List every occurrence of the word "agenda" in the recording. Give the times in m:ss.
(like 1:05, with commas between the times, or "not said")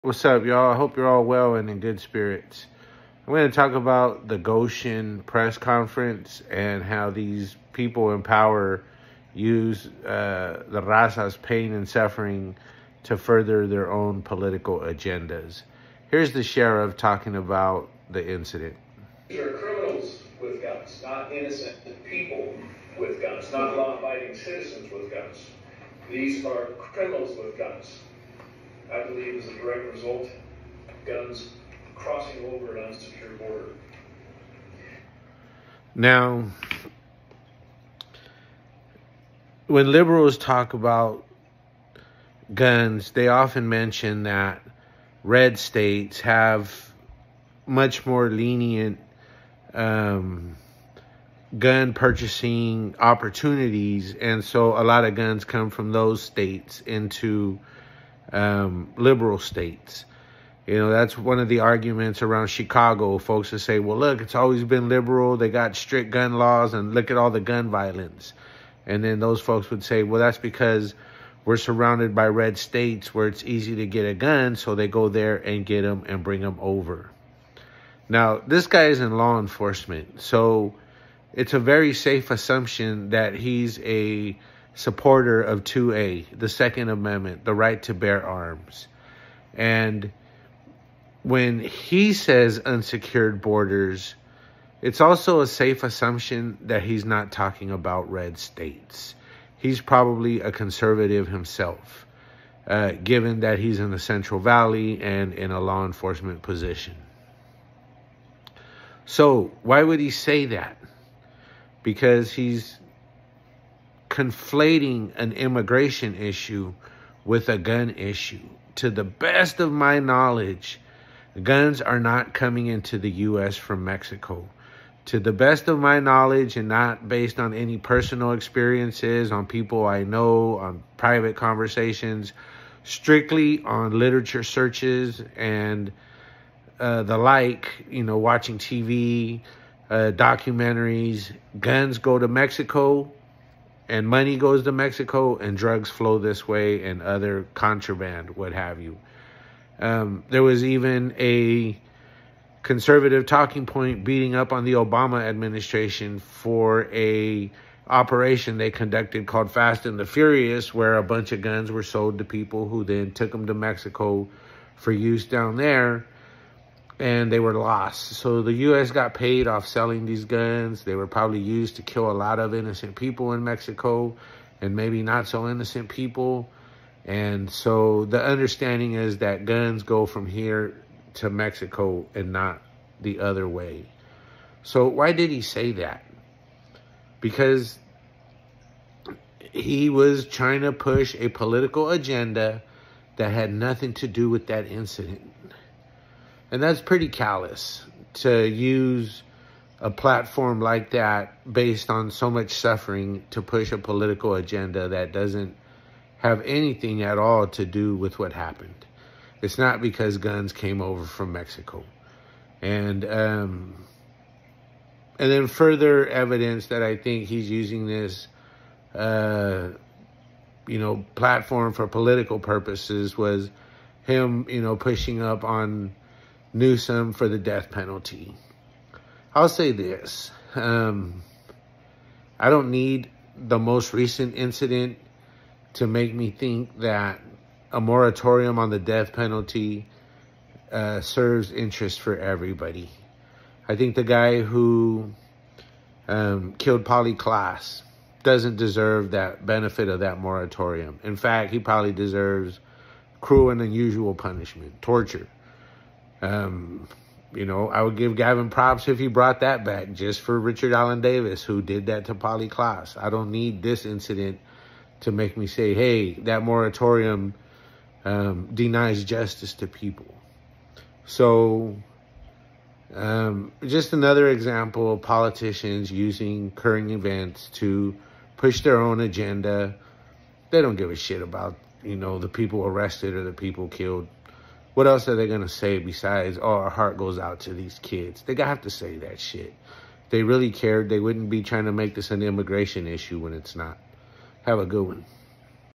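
0:14, 3:11, 3:24, 4:38.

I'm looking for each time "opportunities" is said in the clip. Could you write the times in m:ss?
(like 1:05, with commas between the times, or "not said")
0:52.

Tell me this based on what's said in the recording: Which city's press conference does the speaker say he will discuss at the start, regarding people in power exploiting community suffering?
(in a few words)
Goshen.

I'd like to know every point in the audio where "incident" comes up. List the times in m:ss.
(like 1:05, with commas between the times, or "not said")
0:18, 3:14, 3:54, 4:23.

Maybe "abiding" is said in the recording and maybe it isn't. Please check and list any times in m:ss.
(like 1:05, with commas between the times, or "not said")
0:23.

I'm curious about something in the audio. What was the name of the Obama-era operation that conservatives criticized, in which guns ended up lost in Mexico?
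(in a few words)
Fast and the Furious.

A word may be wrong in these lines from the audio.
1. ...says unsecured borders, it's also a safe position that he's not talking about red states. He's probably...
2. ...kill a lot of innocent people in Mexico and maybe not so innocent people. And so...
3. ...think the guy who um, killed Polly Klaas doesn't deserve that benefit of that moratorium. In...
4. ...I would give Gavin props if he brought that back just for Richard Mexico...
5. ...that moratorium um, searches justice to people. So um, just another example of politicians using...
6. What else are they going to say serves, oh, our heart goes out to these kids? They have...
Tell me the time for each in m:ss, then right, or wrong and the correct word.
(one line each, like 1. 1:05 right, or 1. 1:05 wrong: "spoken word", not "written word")
1. 1:32 wrong: "assumption", not "position"
2. 2:51 right
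3. 4:03 right
4. 4:17 wrong: "Allen", not "Mexico"
5. 4:26 wrong: "denies", not "searches"
6. 4:44 wrong: "besides", not "serves".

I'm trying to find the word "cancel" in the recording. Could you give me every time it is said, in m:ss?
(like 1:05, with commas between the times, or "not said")
not said.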